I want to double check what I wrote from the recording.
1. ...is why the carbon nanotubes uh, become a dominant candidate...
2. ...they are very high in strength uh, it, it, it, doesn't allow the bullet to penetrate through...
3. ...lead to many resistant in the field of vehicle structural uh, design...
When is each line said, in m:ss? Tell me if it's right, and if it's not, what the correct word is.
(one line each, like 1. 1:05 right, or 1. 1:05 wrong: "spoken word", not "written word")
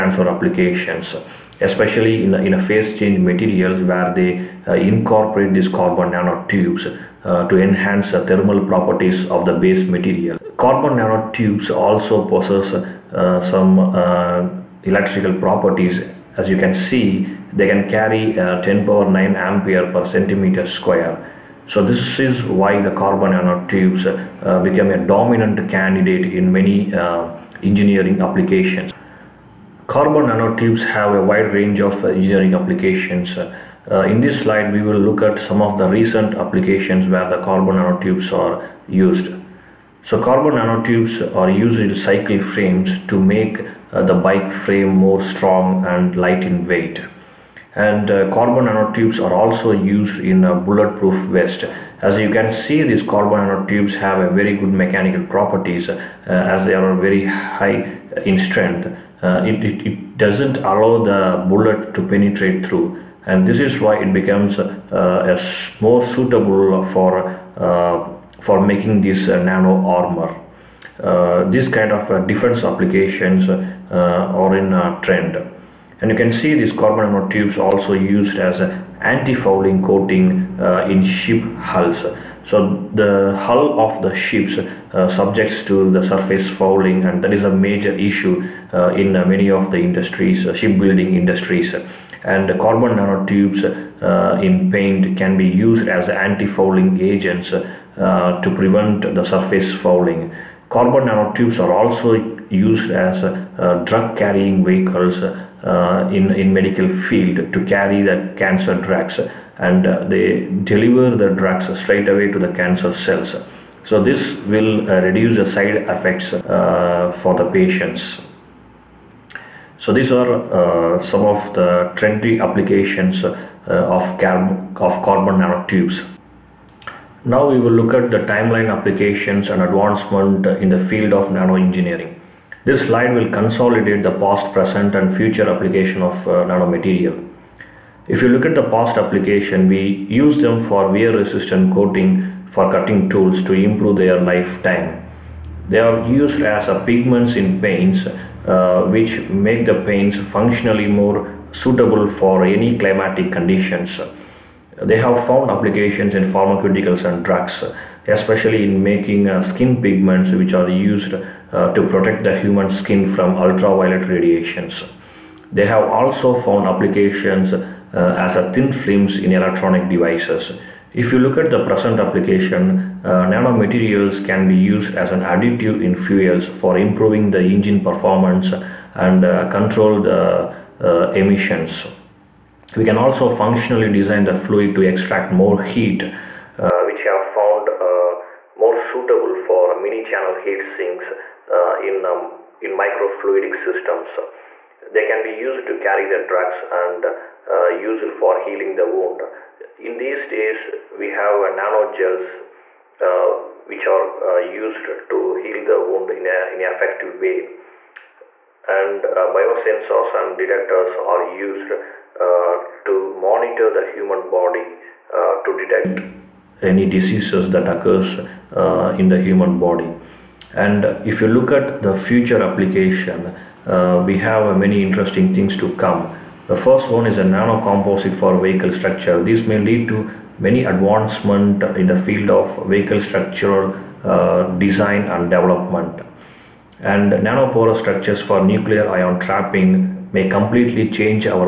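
1. 0:22 right
2. 0:56 right
3. 3:49 wrong: "advancement", not "resistant".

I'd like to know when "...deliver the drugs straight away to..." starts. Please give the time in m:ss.
1:50.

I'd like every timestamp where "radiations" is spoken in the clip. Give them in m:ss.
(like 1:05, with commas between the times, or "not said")
2:44.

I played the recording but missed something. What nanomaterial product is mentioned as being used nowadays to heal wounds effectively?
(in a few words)
Nano gels.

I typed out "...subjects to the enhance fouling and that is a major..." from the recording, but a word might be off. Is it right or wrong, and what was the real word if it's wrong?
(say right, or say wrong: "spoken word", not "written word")
wrong: "surface", not "enhance".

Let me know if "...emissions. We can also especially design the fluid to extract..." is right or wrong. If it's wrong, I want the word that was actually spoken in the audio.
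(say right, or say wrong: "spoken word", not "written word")
wrong: "functionally", not "especially".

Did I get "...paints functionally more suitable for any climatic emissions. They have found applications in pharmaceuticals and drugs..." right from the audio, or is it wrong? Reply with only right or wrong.
wrong.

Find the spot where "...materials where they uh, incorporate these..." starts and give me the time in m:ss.
0:03.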